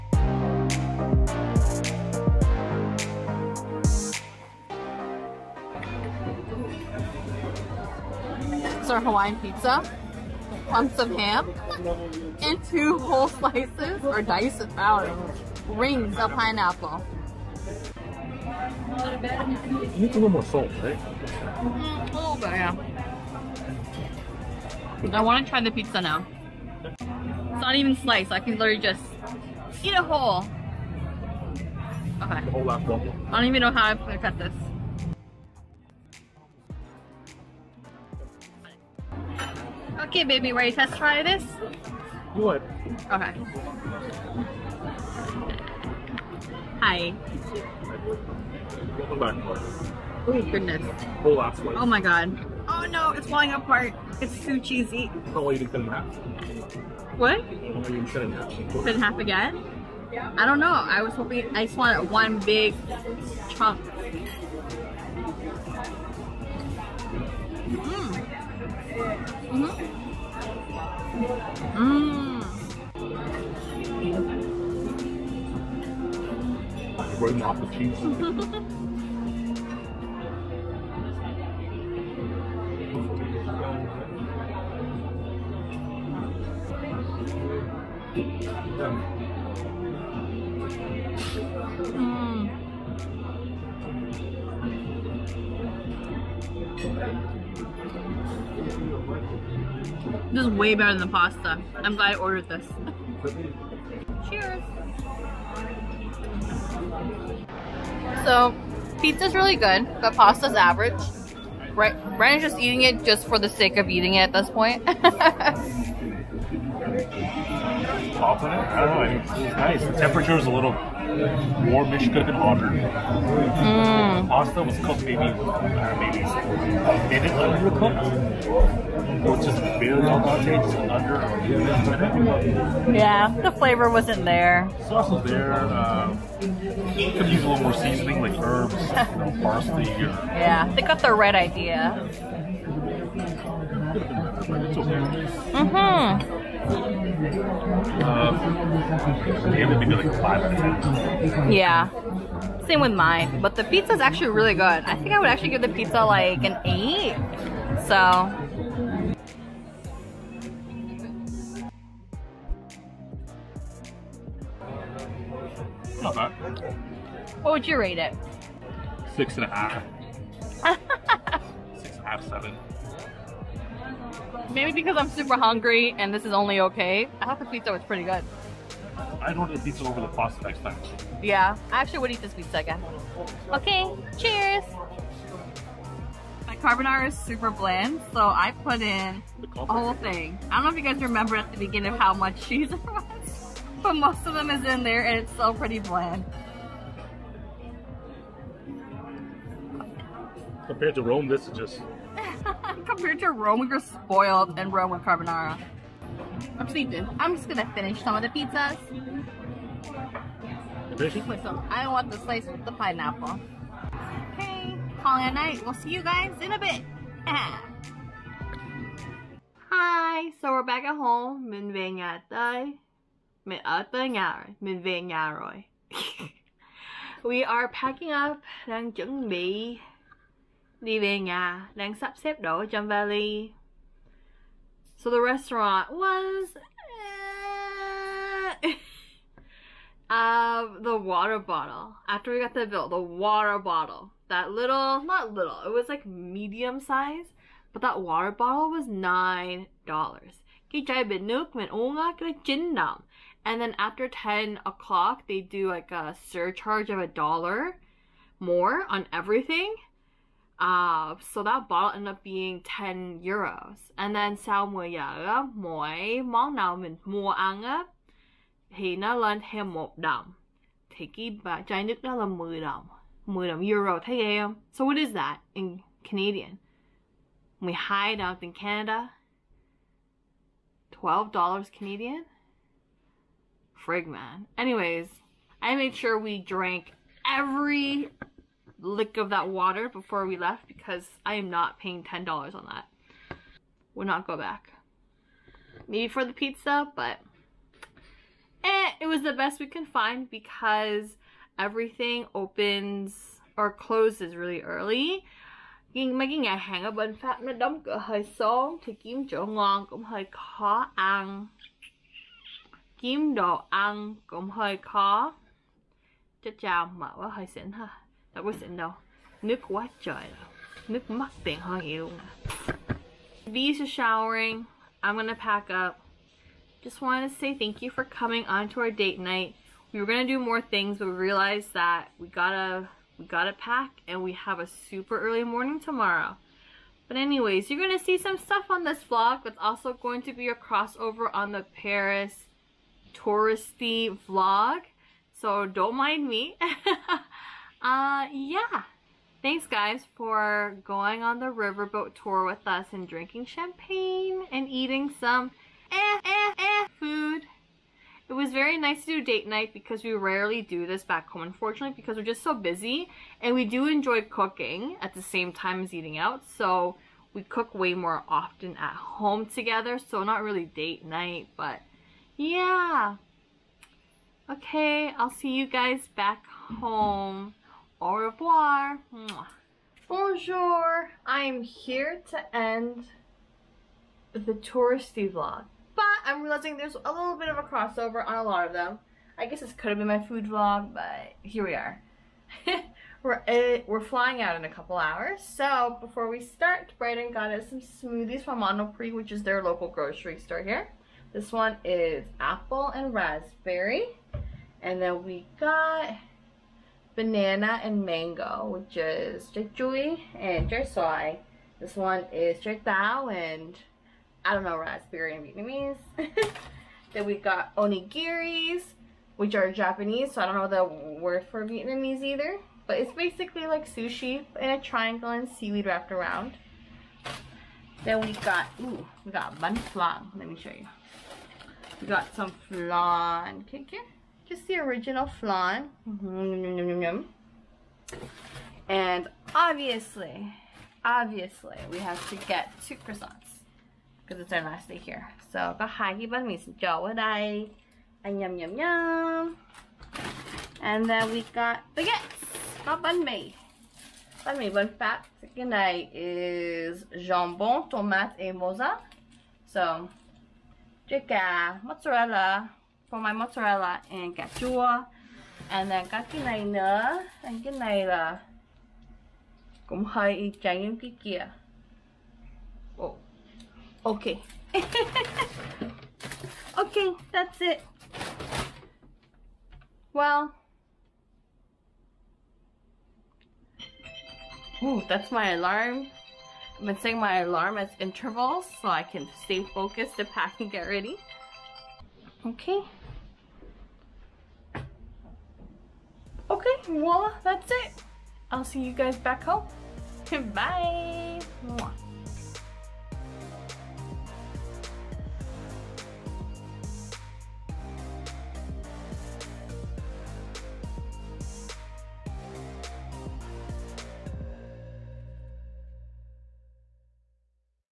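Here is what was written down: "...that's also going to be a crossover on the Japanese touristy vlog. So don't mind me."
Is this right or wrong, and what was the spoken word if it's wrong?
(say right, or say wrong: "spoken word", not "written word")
wrong: "Paris", not "Japanese".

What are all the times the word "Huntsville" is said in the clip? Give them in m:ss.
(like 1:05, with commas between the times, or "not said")
not said.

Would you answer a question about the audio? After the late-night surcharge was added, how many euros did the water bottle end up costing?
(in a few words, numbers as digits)
10 euros.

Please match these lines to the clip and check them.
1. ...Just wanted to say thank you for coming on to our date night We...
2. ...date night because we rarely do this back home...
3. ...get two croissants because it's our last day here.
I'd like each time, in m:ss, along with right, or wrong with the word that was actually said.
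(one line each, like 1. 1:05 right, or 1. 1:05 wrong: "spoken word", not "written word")
1. 5:26 right
2. 5:59 right
3. 7:22 right.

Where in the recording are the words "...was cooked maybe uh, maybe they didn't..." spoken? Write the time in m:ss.
2:04.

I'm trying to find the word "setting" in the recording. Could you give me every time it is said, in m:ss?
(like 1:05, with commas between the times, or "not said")
8:06.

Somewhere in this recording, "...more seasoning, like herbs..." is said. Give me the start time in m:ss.
2:17.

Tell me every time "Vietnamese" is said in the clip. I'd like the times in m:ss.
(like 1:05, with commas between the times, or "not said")
6:55, 7:01.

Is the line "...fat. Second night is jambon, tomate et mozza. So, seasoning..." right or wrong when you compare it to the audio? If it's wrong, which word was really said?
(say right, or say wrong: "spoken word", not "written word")
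wrong: "trứng", not "seasoning".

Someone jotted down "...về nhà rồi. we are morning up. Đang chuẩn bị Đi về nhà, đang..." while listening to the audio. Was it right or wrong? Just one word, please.
wrong.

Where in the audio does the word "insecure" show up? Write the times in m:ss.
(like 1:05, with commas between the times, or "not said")
not said.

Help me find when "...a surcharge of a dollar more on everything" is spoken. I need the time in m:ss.
4:15.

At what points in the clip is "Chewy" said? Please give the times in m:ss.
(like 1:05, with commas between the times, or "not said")
6:49.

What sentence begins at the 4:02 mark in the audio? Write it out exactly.
After we got the bill, the water bottle.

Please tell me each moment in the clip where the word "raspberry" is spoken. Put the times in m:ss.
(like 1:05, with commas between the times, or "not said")
6:43, 6:54.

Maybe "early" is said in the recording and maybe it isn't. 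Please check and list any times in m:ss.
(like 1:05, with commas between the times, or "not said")
5:04, 5:35.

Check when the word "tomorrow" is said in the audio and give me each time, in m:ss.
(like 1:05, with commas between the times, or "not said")
5:35.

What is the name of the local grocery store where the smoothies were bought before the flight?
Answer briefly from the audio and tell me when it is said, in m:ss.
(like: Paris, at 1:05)
Monoprix, at 6:38.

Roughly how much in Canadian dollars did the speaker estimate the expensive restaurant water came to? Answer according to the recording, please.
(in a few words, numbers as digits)
12 dollars.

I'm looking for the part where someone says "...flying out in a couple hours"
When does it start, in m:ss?
6:34.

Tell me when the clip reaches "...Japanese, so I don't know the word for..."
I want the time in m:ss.
6:59.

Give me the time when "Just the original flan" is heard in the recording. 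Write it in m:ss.
7:14.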